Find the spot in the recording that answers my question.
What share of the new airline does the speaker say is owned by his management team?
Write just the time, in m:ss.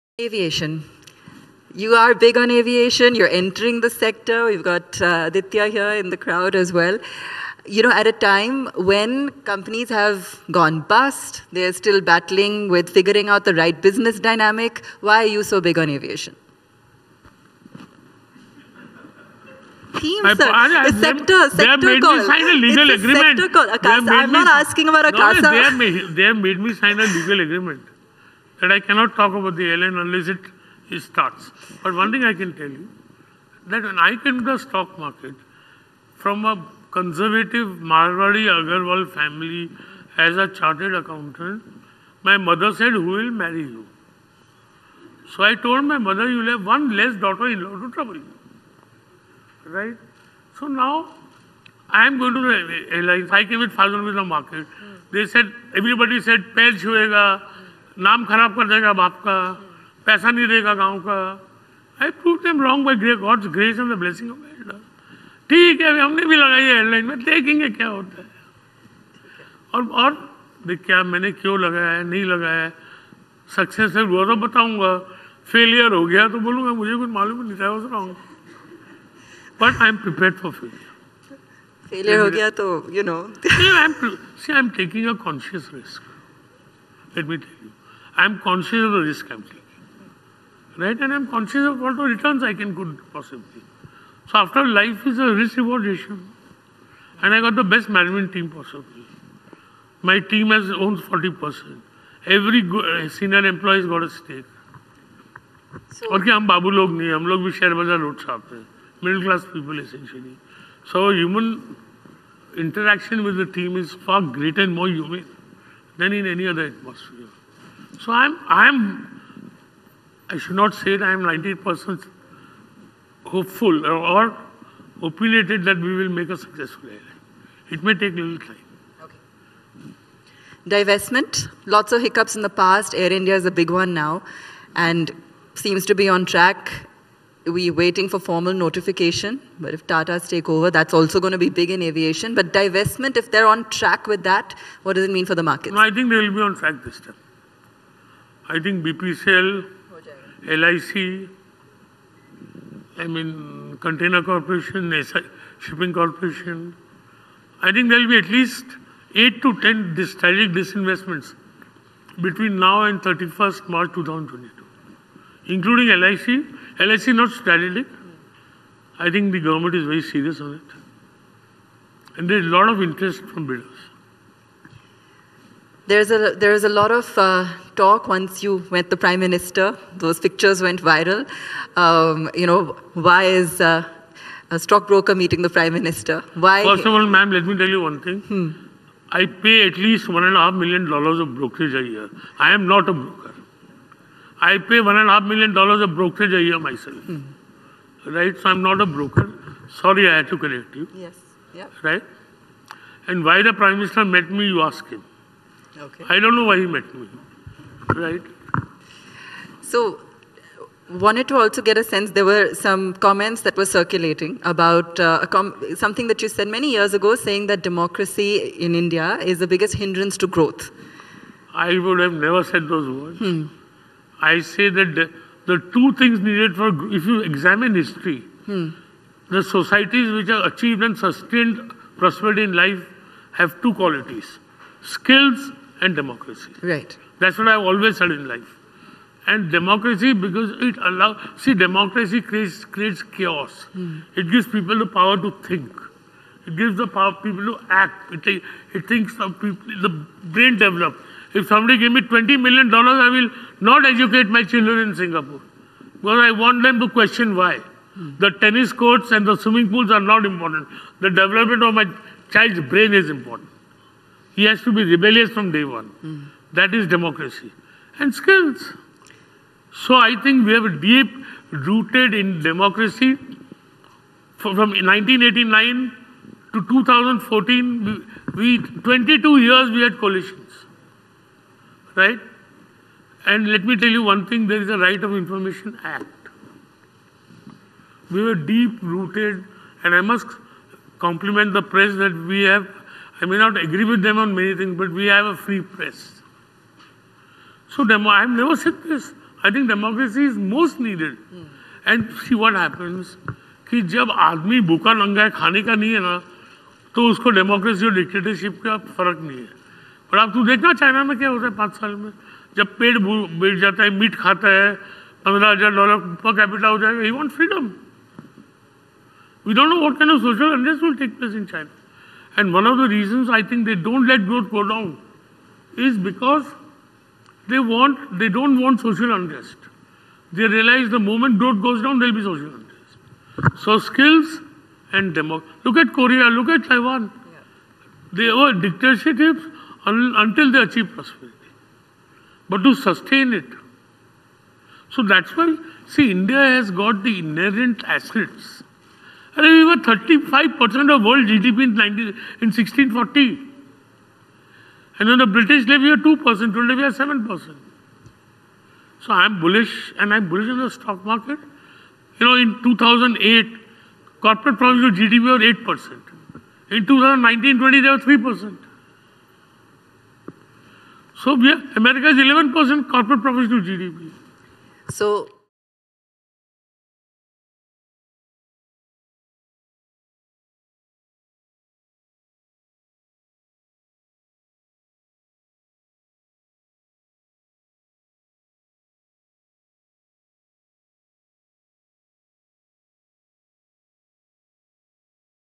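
1:41.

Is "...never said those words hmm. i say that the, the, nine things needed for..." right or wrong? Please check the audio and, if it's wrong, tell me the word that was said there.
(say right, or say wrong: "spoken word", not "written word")
wrong: "two", not "nine".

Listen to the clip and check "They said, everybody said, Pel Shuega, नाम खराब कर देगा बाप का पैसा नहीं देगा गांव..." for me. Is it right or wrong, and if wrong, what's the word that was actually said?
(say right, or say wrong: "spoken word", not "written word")
right.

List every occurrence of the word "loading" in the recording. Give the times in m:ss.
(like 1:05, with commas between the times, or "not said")
not said.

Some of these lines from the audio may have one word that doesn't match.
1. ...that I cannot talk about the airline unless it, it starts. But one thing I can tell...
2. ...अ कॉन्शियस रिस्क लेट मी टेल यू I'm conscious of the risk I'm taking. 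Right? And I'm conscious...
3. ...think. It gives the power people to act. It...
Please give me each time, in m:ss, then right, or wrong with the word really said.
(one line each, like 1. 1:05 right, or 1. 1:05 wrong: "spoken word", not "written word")
1. 0:28 right
2. 1:25 right
3. 4:05 right.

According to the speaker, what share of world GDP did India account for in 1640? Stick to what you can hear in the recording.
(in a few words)
35%.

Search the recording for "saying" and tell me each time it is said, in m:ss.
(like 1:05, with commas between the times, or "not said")
3:37.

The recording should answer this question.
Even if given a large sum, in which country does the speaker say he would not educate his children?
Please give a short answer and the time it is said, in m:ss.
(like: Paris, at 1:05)
Singapore, at 4:14.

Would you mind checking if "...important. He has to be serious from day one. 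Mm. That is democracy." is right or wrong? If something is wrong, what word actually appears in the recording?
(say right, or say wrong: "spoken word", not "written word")
wrong: "rebellious", not "serious".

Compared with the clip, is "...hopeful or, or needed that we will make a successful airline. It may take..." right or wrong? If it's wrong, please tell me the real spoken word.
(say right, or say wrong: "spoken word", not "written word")
wrong: "opinionated", not "needed".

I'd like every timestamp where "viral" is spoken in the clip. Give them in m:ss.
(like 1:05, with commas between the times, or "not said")
3:00.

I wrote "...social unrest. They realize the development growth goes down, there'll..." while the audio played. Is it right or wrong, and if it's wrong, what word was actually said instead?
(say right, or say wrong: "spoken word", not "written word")
wrong: "moment", not "development".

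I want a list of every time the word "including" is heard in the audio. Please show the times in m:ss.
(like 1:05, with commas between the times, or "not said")
2:45.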